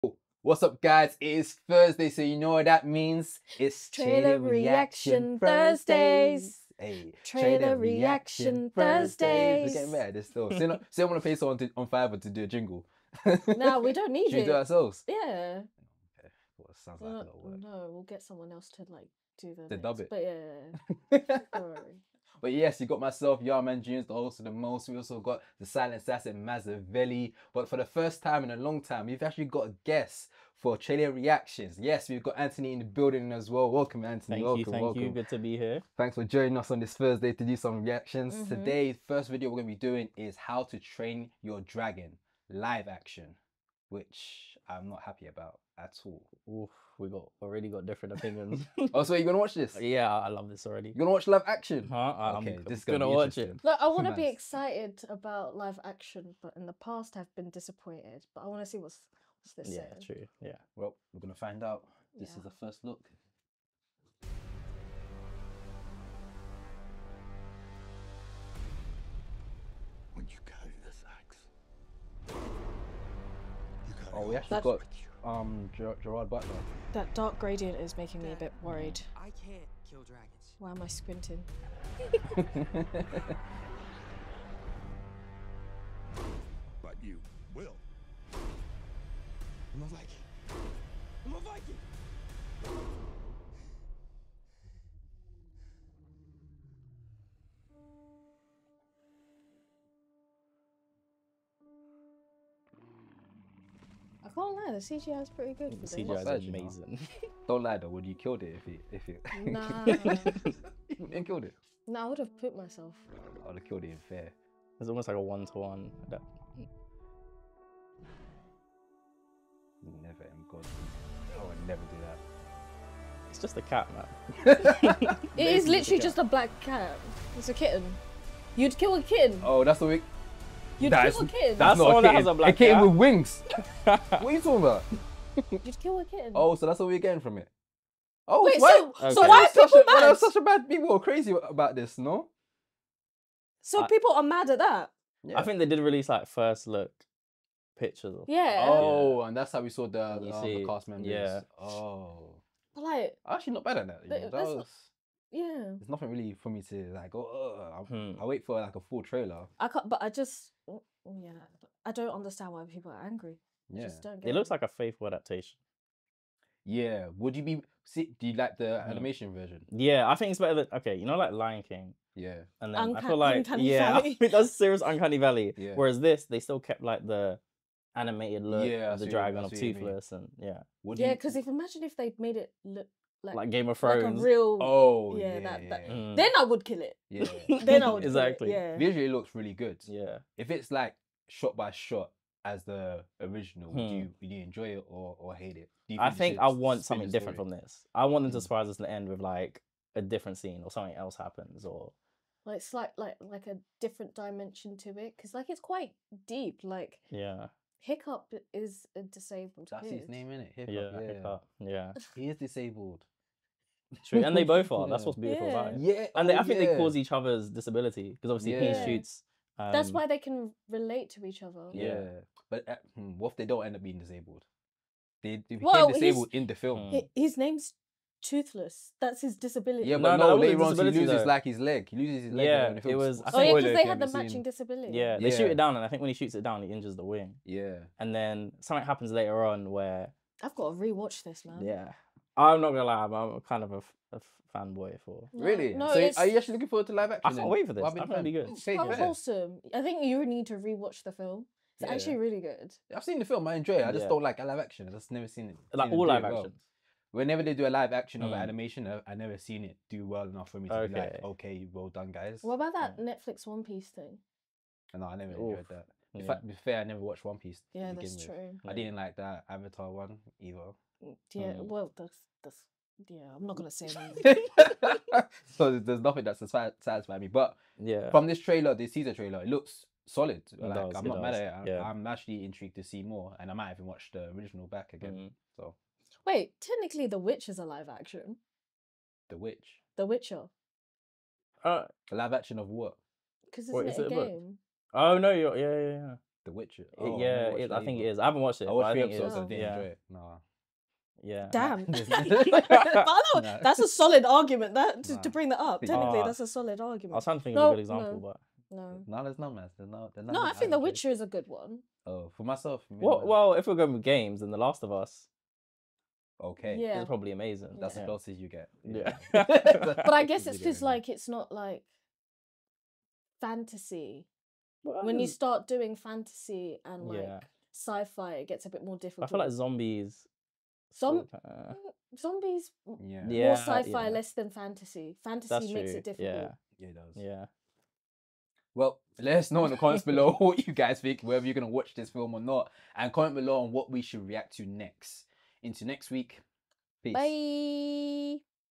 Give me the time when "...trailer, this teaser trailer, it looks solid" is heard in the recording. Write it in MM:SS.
04:38.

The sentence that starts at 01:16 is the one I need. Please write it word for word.
That dark gradient is making me a bit worried.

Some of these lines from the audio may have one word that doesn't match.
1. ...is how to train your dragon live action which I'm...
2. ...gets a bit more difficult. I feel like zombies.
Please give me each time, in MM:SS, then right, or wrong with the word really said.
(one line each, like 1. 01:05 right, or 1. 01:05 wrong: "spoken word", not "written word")
1. 00:40 right
2. 05:28 right.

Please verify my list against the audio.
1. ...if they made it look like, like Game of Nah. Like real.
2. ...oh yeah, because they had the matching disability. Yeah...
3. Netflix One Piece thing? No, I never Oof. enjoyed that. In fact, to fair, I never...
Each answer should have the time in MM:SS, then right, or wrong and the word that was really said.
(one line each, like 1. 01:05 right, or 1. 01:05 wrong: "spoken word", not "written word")
1. 03:01 wrong: "Thrones", not "Nah"
2. 03:53 right
3. 04:23 right.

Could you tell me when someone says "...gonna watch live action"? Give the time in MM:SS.
00:50.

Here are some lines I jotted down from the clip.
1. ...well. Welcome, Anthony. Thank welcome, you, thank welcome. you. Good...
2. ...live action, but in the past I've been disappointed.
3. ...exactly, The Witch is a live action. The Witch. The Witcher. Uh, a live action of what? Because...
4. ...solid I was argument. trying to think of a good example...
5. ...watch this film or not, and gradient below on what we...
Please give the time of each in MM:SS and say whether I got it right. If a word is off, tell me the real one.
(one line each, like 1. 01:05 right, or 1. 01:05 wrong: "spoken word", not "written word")
1. 00:33 right
2. 00:55 right
3. 04:46 wrong: "technically", not "exactly"
4. 05:06 right
5. 05:41 wrong: "comment", not "gradient".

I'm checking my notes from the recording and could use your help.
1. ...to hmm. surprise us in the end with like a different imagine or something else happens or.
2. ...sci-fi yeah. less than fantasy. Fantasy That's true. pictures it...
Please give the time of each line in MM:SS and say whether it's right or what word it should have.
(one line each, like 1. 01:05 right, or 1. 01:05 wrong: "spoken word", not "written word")
1. 03:18 wrong: "scene", not "imagine"
2. 05:33 wrong: "makes", not "pictures".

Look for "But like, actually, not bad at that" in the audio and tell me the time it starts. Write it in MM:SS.
02:32.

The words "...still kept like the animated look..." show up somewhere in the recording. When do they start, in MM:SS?
02:56.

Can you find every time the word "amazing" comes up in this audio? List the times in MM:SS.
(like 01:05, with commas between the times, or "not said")
01:46, 05:17.